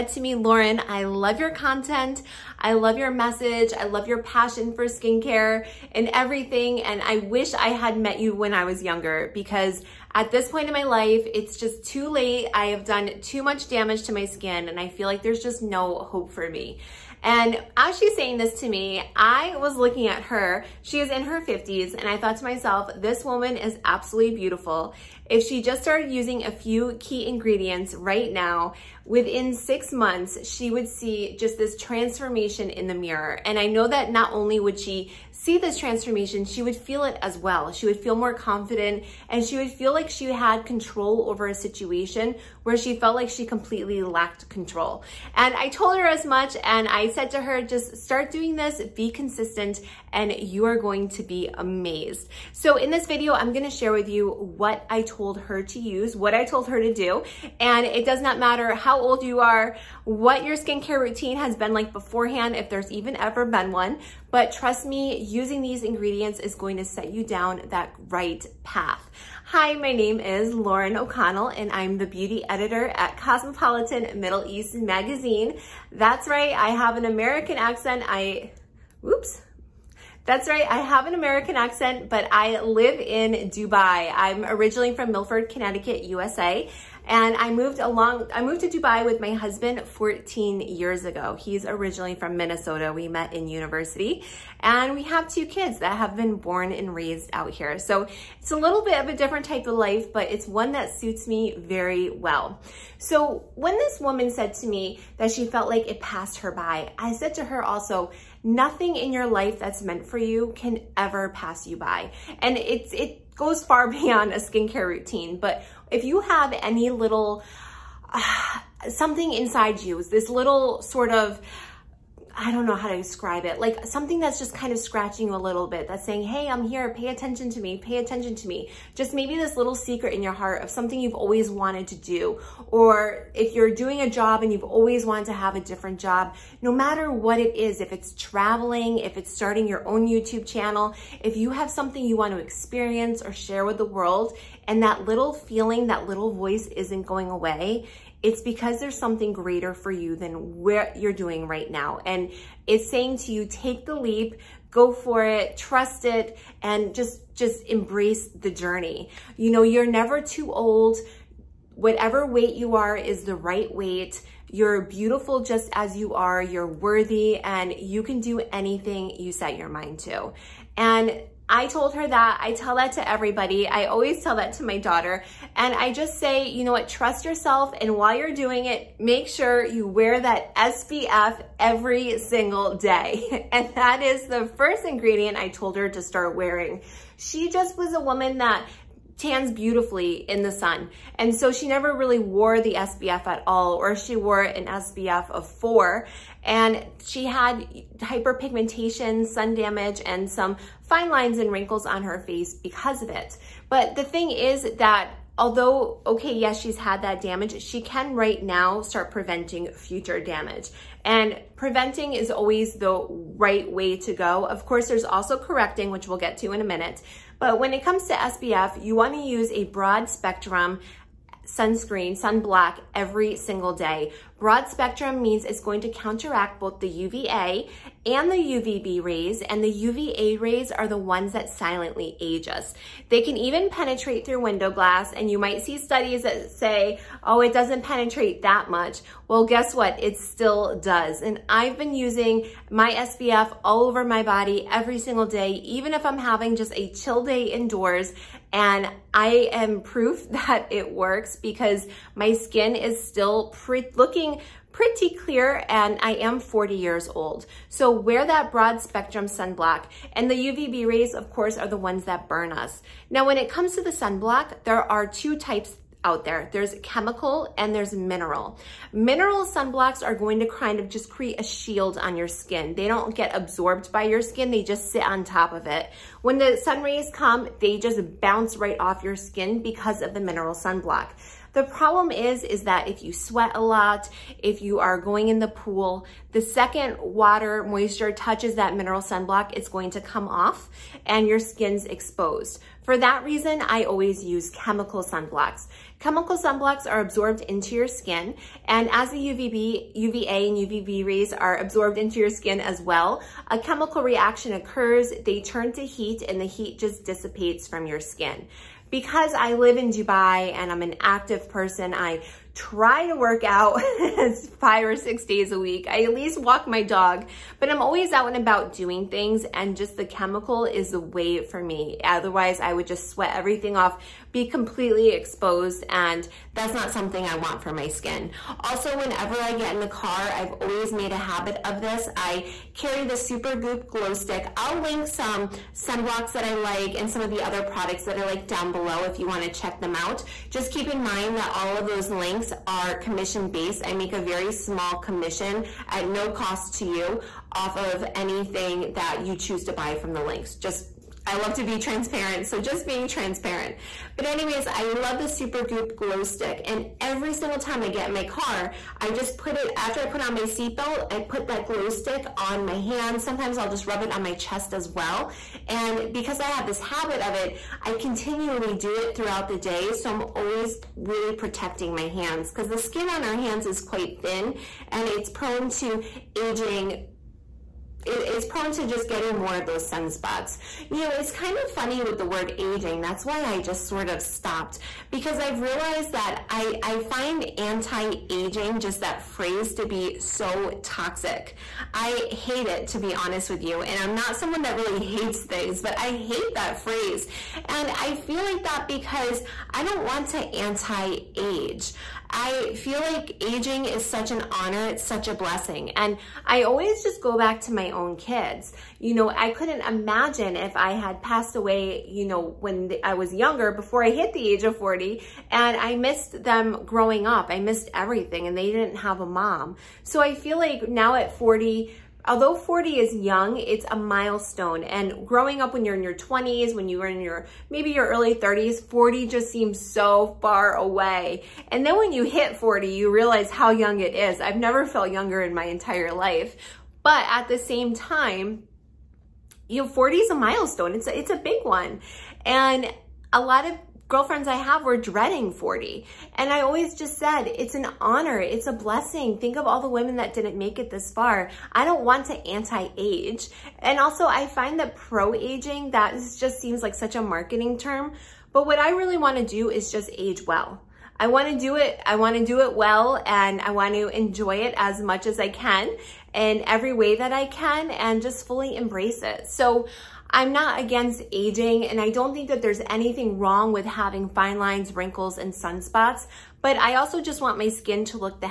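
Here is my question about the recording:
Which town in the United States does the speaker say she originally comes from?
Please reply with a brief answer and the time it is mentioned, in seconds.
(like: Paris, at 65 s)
Milford, Connecticut, at 85 s.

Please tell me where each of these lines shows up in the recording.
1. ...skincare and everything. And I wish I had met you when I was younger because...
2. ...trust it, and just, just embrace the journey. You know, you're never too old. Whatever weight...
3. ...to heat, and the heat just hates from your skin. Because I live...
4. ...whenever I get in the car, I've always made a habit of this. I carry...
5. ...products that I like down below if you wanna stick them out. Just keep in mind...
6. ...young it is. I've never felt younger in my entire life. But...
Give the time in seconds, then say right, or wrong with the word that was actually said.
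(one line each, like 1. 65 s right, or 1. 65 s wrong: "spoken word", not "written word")
1. 4 s right
2. 155 s right
3. 305 s wrong: "dissipates", not "hates"
4. 328 s right
5. 337 s wrong: "check", not "stick"
6. 433 s right.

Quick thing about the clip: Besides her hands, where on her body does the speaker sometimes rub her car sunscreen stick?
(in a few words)
Chest.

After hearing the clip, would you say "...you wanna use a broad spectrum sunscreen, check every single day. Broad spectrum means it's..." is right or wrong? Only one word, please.
wrong.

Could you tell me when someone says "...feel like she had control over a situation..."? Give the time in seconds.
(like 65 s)
39 s.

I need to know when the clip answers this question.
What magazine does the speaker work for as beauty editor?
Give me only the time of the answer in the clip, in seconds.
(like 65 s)
73 s.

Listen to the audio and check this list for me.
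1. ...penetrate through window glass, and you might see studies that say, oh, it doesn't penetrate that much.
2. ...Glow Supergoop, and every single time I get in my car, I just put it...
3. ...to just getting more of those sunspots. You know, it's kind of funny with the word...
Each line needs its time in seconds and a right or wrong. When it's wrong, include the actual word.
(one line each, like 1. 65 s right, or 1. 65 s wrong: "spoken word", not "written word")
1. 233 s right
2. 355 s wrong: "Stick", not "Supergoop"
3. 378 s right.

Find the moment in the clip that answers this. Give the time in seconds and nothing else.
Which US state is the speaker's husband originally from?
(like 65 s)
92 s.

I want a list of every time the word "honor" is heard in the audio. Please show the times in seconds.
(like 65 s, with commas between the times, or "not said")
404 s, 447 s.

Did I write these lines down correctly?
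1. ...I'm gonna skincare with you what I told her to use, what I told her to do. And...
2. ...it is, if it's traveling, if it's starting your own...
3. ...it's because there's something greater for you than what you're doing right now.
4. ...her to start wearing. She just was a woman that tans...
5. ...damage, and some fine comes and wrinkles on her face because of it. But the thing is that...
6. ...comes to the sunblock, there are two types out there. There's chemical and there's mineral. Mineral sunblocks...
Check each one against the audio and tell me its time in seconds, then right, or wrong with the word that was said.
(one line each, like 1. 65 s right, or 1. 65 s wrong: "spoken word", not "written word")
1. 53 s wrong: "share", not "skincare"
2. 137 s right
3. 148 s right
4. 185 s right
5. 199 s wrong: "lines", not "comes"
6. 263 s right.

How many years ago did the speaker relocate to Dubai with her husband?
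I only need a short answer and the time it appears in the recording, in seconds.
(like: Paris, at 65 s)
14, at 89 s.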